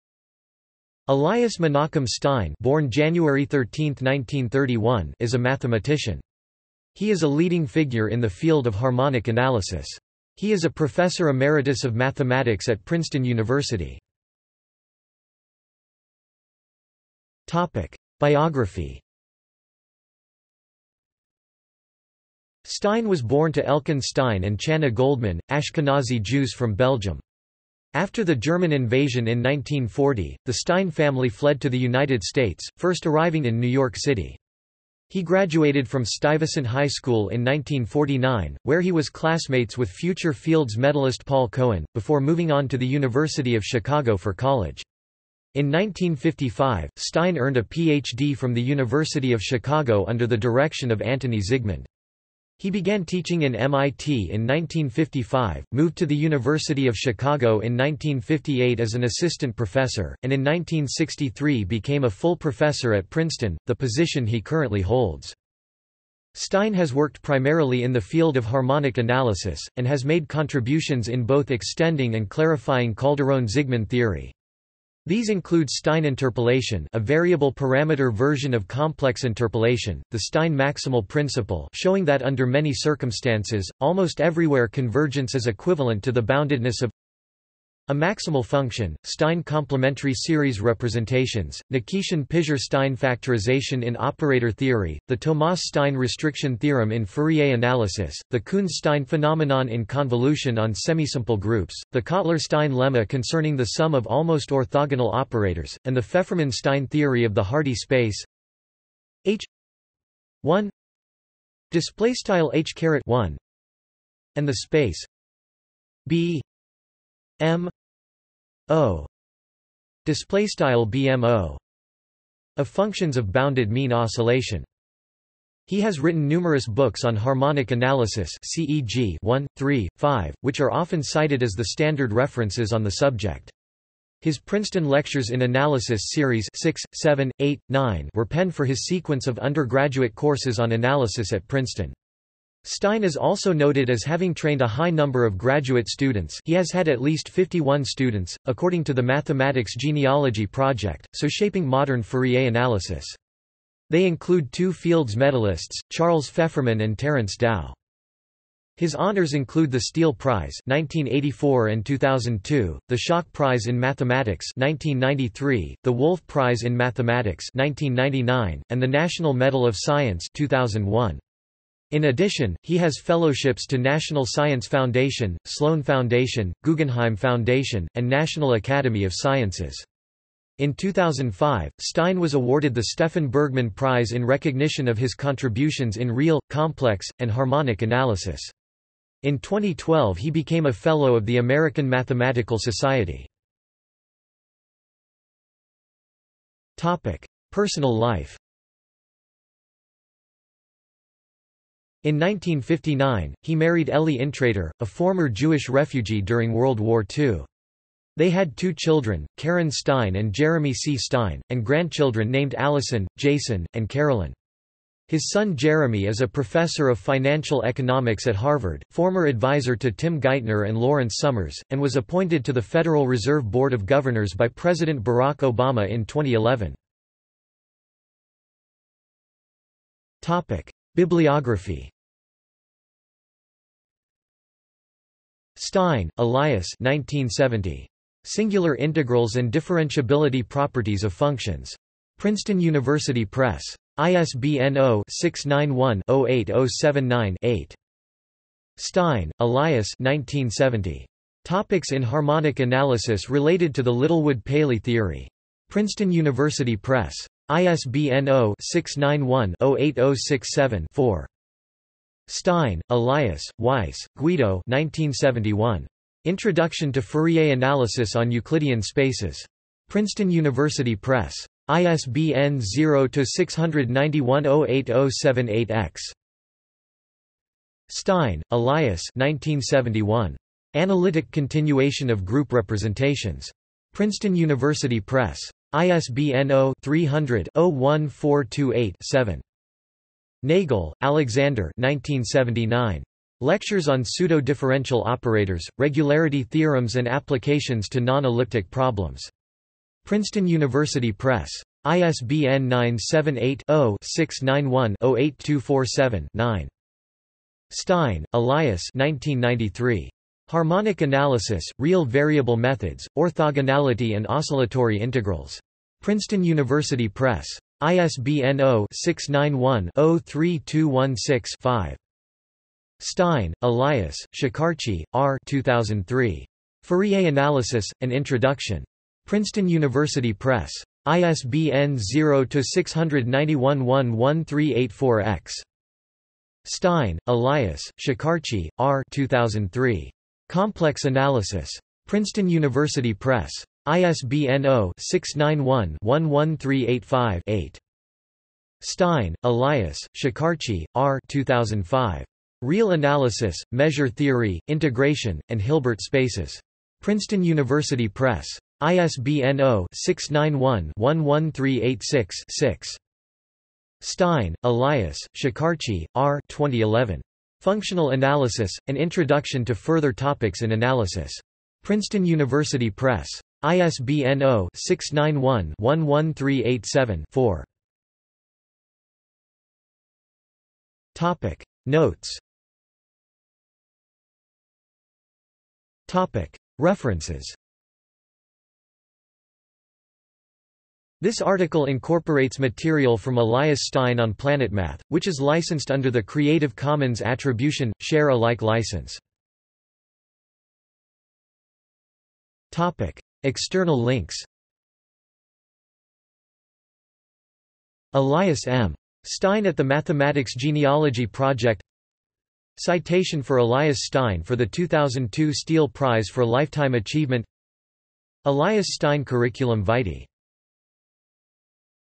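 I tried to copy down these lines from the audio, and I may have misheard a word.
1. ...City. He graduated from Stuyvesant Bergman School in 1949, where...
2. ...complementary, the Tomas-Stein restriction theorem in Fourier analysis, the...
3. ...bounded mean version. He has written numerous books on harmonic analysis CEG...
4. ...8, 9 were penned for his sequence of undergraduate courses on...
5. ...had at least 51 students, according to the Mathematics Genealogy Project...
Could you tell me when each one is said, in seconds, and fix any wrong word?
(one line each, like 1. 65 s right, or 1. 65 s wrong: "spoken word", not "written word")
1. 33 s wrong: "High", not "Bergman"
2. 94 s wrong: "theory", not "complementary"
3. 123 s wrong: "oscillation", not "version"
4. 137 s right
5. 146 s right.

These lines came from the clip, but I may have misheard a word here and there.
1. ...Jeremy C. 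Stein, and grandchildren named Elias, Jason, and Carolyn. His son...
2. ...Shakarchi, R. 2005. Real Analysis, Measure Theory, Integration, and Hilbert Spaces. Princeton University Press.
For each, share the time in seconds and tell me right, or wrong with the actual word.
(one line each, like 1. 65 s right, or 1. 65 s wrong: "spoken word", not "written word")
1. 210 s wrong: "Allison", not "Elias"
2. 350 s right.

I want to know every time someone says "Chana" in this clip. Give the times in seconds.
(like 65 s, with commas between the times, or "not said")
24 s.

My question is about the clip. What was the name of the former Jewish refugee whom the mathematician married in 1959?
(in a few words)
Elly Intrater.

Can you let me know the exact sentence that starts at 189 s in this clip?
In 2012 he became a Fellow of the American Mathematical Society.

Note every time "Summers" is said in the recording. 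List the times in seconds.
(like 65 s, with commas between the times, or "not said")
221 s.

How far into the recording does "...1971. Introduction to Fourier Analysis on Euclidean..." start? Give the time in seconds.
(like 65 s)
264 s.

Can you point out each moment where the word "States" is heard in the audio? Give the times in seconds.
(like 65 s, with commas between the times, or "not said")
32 s.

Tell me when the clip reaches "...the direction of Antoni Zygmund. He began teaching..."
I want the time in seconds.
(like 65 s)
50 s.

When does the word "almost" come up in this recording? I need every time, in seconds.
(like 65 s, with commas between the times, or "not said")
83 s, 104 s.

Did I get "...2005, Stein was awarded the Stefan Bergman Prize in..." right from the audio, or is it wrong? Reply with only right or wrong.
right.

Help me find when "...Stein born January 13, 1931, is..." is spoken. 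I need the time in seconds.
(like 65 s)
2 s.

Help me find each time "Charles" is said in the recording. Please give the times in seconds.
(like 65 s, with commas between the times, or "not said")
155 s.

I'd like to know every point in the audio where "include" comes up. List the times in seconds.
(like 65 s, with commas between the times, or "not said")
75 s, 154 s, 159 s.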